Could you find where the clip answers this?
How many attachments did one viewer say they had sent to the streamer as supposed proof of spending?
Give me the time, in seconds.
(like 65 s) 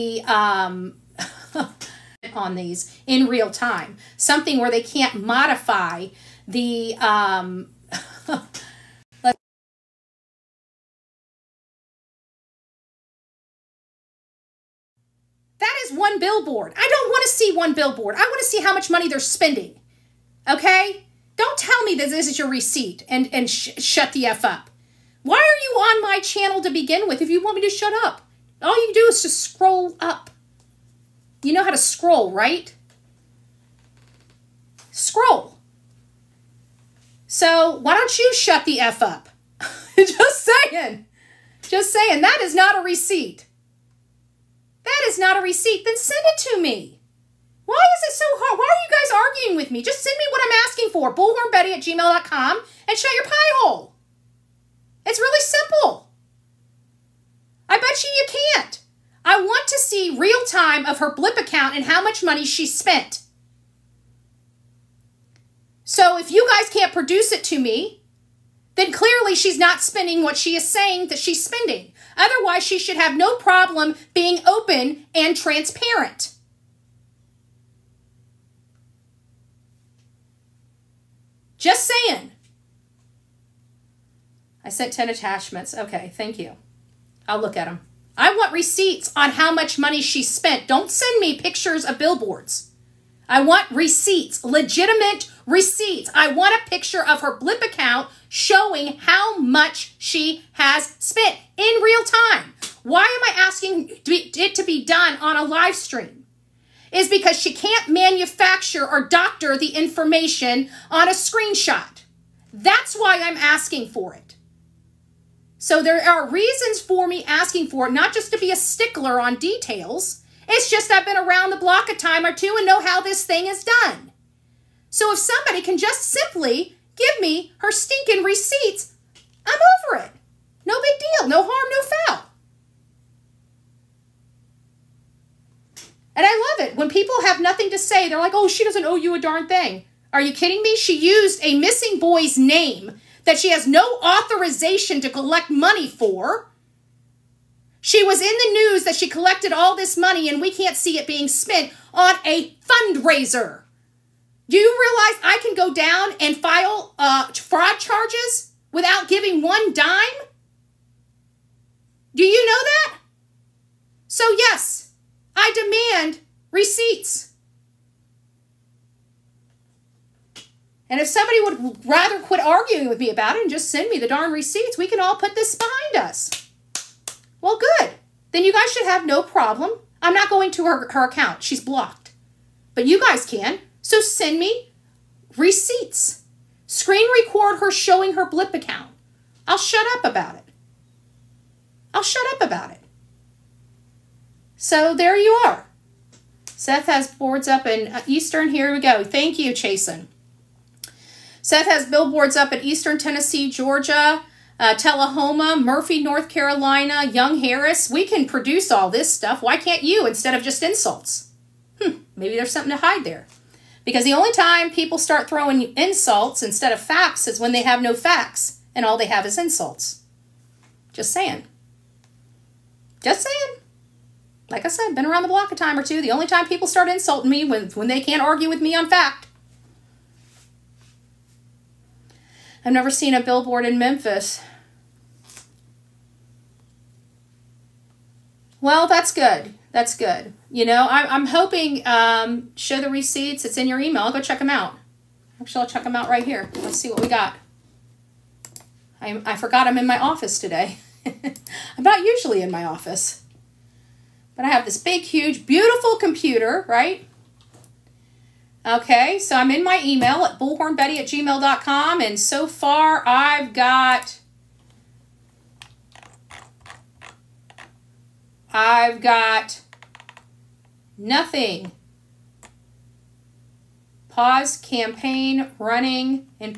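84 s.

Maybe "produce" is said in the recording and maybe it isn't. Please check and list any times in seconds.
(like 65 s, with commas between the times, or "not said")
66 s, 208 s.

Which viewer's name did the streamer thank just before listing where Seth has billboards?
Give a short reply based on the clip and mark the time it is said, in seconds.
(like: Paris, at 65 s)
Chasen, at 199 s.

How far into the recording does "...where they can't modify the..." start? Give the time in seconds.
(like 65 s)
4 s.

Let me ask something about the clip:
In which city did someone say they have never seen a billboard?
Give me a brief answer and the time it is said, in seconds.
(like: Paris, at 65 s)
Memphis, at 233 s.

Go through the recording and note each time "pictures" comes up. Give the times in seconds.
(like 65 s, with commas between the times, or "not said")
91 s, 96 s.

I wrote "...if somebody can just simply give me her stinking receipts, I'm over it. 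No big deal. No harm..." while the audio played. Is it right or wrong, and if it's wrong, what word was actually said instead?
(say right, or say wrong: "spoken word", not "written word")
right.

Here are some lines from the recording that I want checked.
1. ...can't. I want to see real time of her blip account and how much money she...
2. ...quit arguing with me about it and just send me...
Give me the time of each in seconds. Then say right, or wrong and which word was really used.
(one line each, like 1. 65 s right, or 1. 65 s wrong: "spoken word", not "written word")
1. 58 s right
2. 172 s right.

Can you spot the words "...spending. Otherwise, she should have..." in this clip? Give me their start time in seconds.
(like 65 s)
71 s.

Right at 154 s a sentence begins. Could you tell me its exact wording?
Do you realize I can go down and file uh, fraud charges without giving one dime?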